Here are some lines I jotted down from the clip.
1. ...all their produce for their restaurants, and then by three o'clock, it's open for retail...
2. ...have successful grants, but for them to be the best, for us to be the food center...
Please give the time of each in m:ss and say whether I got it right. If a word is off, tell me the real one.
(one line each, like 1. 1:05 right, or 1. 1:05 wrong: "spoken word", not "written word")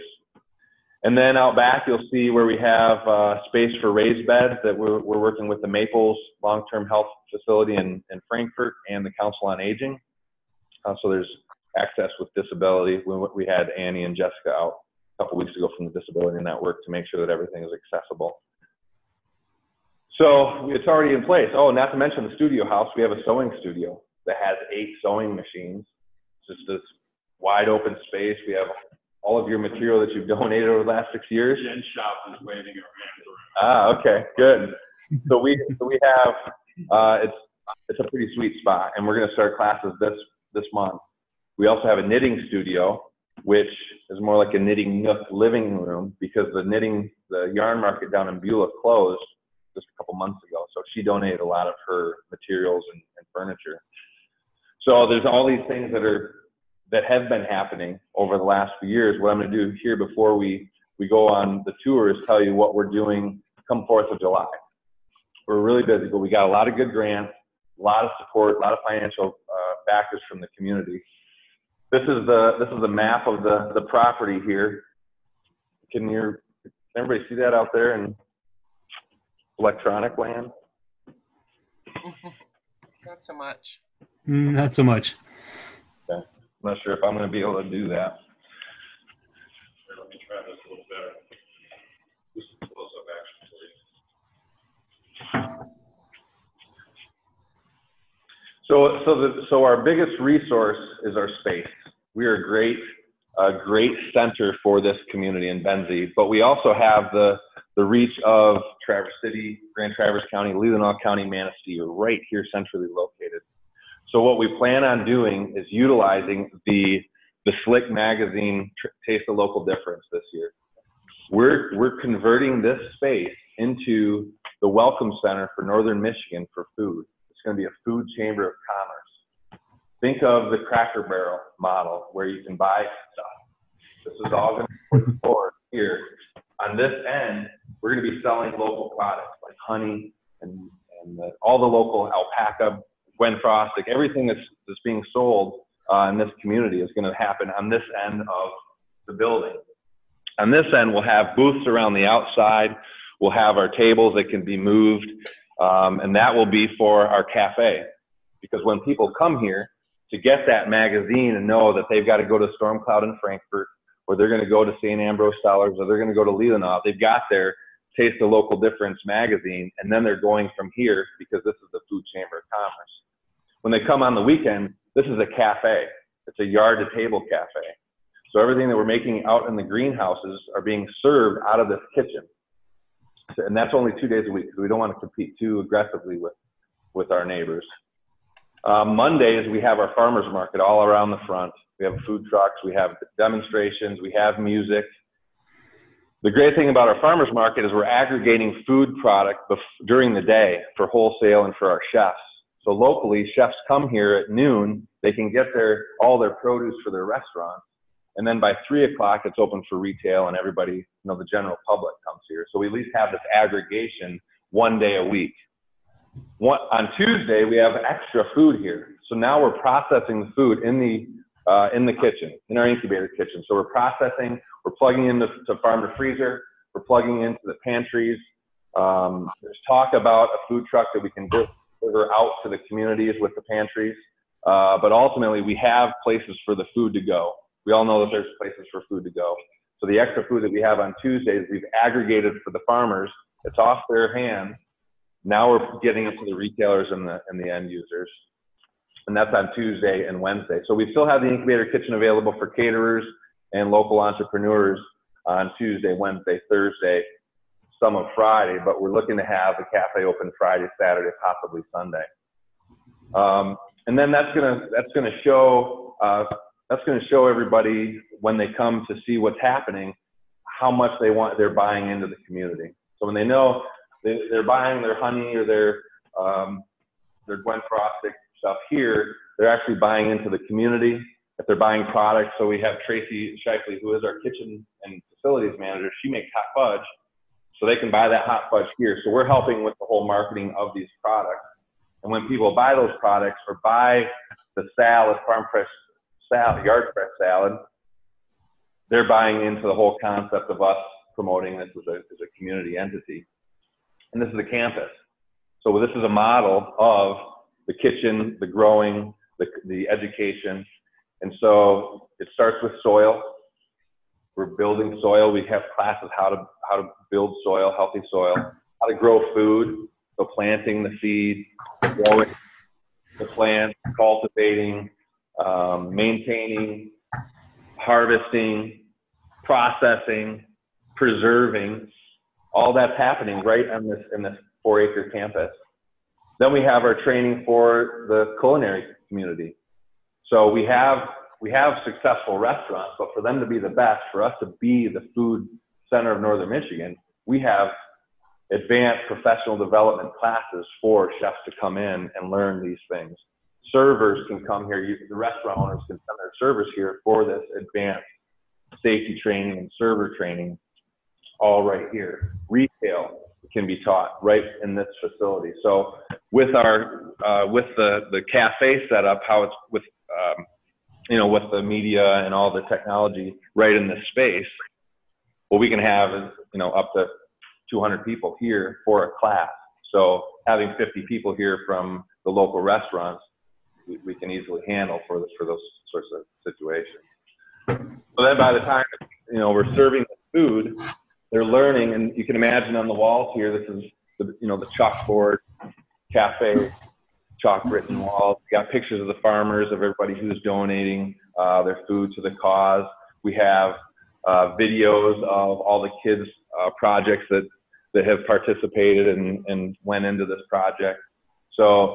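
1. 3:26 right
2. 5:41 wrong: "restaurants", not "grants".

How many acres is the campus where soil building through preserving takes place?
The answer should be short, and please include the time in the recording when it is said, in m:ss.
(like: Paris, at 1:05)
4 acres, at 5:34.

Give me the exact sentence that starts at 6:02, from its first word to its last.
Retail can be taught right in this facility.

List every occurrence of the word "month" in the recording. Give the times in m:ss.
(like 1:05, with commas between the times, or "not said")
0:40, 0:50.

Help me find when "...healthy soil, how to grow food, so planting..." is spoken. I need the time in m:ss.
5:17.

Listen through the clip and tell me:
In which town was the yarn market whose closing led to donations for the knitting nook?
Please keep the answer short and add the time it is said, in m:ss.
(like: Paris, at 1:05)
Beulah, at 0:48.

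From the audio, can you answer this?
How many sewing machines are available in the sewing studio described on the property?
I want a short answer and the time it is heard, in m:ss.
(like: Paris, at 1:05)
8, at 0:24.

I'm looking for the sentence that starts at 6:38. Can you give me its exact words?
We got pictures of the farmers, of everybody who's donating uh, their food to the cause.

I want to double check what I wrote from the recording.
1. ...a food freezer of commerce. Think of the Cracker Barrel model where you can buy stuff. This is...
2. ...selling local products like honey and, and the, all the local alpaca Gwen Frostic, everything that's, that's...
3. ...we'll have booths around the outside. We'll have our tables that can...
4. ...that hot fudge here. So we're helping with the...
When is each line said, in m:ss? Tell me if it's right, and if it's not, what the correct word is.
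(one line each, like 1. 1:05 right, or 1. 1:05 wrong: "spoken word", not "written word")
1. 2:07 wrong: "chamber", not "freezer"
2. 2:18 right
3. 2:30 right
4. 4:48 right.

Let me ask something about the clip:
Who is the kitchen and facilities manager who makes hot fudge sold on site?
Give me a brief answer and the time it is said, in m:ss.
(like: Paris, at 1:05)
Tracy Shifley, at 4:42.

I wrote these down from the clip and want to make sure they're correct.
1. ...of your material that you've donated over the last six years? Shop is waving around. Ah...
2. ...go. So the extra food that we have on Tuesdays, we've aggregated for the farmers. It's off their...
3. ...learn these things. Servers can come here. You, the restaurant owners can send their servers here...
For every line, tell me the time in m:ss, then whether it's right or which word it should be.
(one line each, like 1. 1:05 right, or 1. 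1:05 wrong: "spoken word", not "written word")
1. 0:29 right
2. 3:59 right
3. 5:52 right.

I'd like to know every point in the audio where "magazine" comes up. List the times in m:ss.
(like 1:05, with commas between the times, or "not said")
1:57, 2:40, 2:49.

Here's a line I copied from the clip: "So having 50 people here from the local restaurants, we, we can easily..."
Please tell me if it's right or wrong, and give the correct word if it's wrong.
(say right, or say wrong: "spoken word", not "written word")
right.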